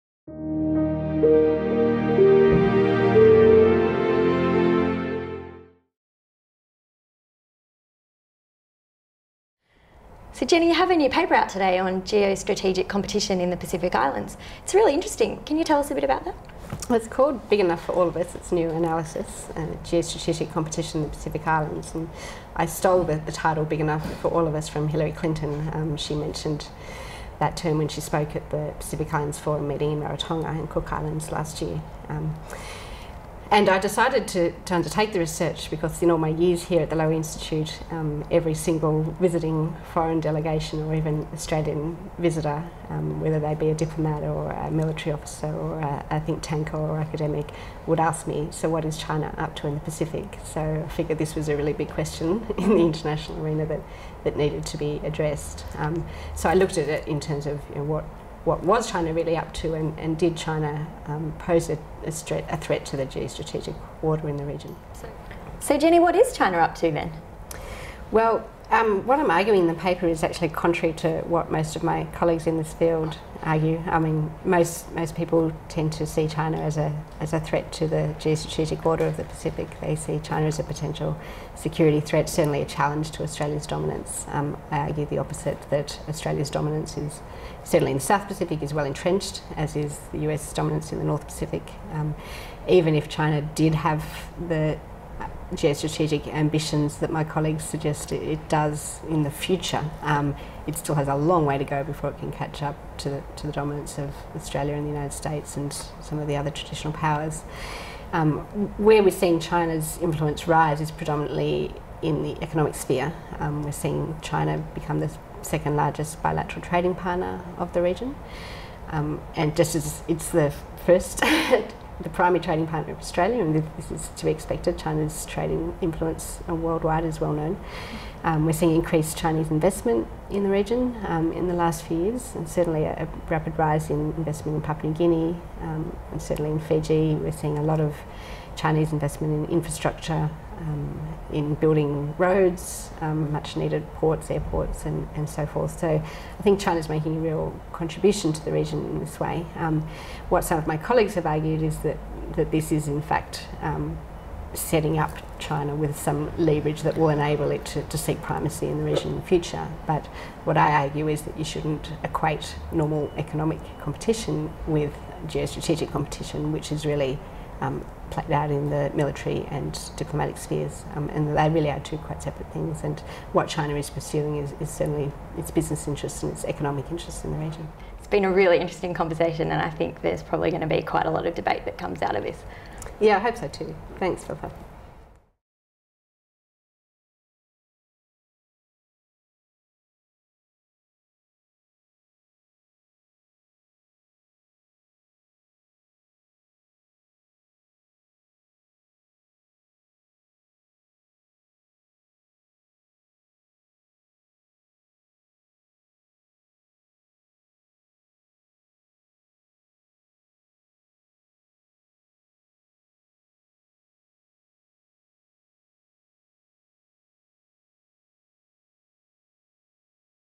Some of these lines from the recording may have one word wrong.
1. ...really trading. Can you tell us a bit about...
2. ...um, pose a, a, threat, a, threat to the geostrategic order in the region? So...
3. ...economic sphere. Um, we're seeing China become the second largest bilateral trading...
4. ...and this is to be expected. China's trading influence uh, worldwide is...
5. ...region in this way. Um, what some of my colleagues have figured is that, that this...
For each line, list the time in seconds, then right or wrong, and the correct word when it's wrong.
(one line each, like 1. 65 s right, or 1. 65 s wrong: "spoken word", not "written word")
1. 14 s wrong: "interesting", not "trading"
2. 61 s right
3. 112 s right
4. 123 s right
5. 148 s wrong: "argued", not "figured".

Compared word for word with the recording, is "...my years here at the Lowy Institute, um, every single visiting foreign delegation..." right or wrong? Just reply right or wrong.
right.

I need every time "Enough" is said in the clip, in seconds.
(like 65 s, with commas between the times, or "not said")
17 s, 23 s.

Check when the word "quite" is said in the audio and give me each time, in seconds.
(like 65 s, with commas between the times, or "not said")
171 s, 180 s.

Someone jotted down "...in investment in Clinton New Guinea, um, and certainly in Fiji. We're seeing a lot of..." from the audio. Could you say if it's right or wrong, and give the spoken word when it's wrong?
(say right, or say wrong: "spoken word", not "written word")
wrong: "Papua", not "Clinton".